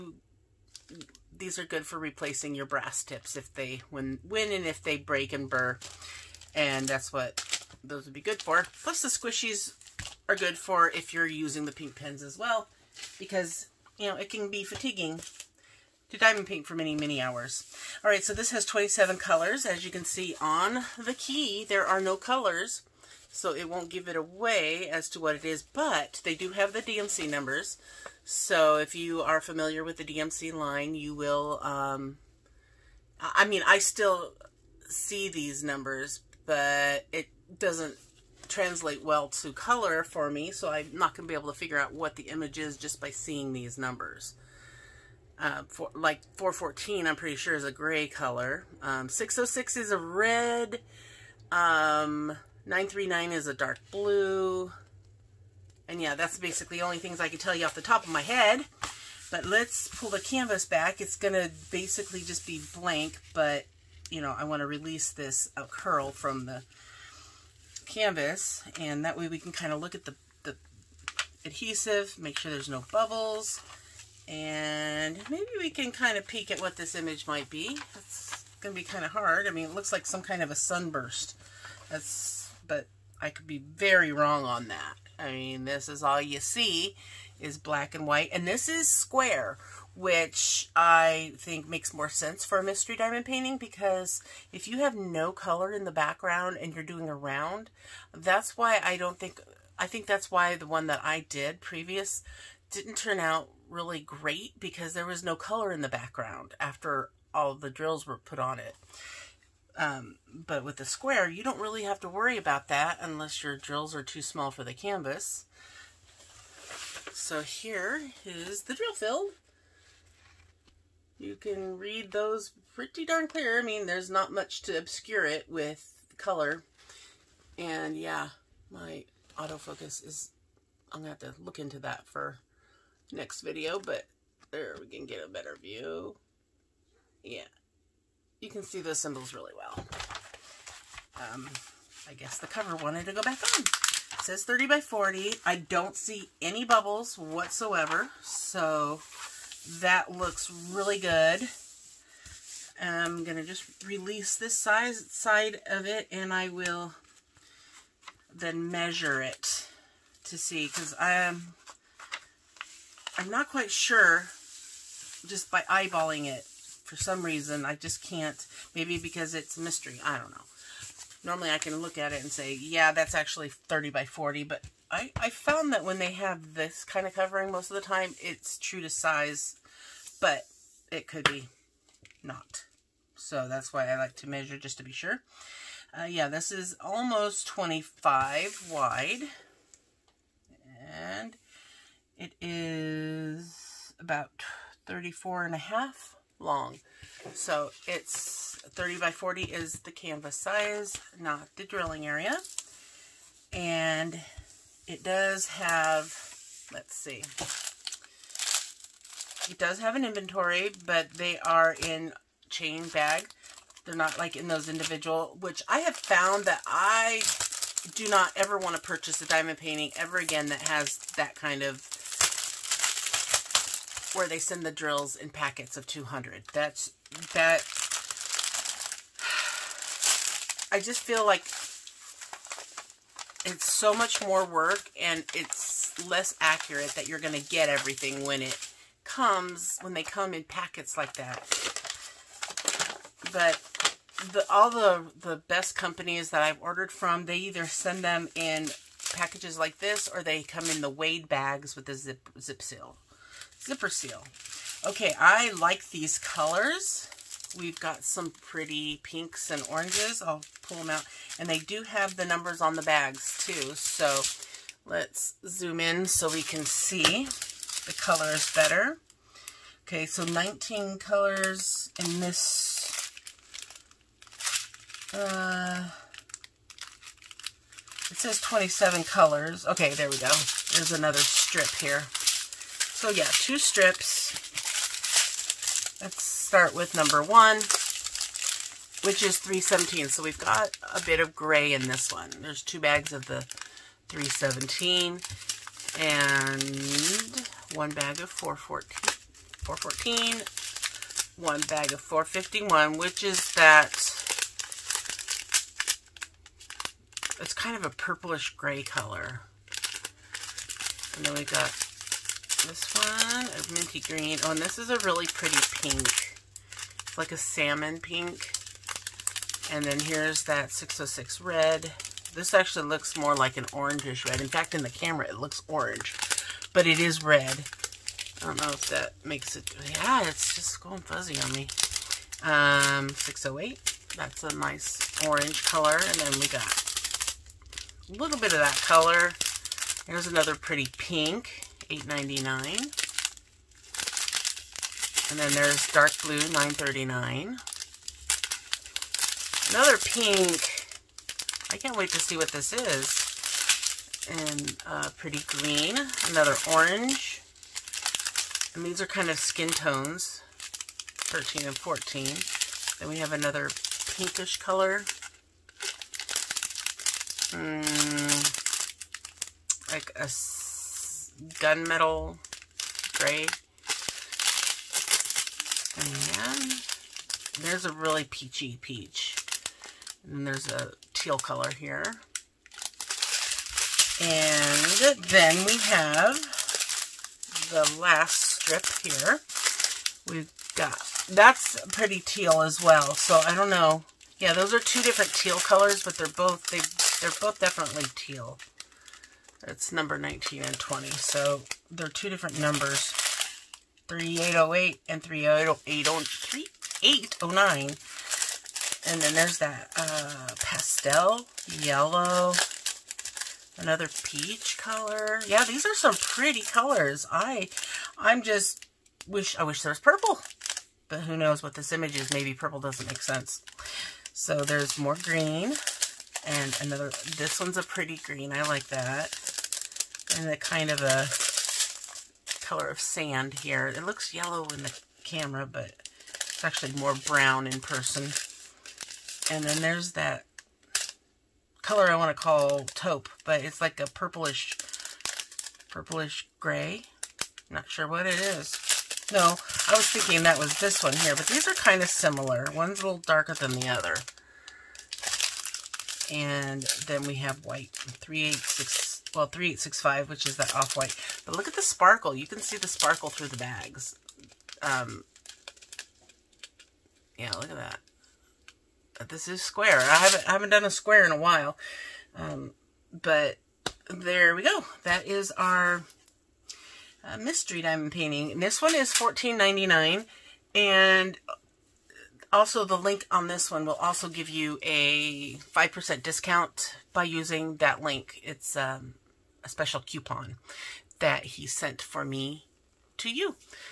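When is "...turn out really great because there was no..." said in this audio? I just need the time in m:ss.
1:42.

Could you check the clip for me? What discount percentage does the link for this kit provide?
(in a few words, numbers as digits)
5%.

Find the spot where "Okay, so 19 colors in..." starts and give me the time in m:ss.
4:29.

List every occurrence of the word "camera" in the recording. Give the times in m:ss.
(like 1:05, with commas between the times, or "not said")
5:24, 7:15.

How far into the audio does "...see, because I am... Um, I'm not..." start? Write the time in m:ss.
2:40.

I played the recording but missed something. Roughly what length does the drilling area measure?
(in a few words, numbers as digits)
34 and a half.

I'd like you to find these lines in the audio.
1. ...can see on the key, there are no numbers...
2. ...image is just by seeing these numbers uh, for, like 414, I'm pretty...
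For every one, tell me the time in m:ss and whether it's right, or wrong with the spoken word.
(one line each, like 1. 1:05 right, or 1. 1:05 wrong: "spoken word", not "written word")
1. 0:19 wrong: "colors", not "numbers"
2. 0:42 right.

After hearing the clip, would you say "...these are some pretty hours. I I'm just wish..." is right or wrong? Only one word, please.
wrong.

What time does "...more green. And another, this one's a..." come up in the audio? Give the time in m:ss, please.
7:04.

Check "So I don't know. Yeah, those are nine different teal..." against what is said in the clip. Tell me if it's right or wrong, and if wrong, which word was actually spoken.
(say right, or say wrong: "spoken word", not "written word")
wrong: "two", not "nine".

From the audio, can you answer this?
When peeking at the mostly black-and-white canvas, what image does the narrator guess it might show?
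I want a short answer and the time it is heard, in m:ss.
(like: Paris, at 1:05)
a sunburst, at 1:20.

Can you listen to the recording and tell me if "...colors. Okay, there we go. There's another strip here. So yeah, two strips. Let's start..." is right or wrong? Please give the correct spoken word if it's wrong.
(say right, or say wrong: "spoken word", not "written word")
right.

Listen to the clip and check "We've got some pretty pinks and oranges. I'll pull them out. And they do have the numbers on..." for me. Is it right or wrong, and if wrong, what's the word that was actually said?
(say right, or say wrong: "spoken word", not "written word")
right.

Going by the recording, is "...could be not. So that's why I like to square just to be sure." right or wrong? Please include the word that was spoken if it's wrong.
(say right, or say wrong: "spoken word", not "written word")
wrong: "measure", not "square".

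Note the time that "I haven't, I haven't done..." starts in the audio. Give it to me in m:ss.
7:49.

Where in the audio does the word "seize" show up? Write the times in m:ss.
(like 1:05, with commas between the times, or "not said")
not said.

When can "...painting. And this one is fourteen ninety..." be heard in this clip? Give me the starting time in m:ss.
7:58.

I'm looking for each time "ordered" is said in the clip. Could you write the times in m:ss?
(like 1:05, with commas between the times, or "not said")
4:06.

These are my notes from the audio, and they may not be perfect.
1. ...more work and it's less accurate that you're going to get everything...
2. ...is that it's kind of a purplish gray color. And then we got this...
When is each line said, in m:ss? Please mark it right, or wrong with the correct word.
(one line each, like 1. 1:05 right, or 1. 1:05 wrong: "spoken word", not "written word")
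1. 3:54 right
2. 5:03 right.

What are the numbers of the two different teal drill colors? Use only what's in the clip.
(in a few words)
3808 and 3809.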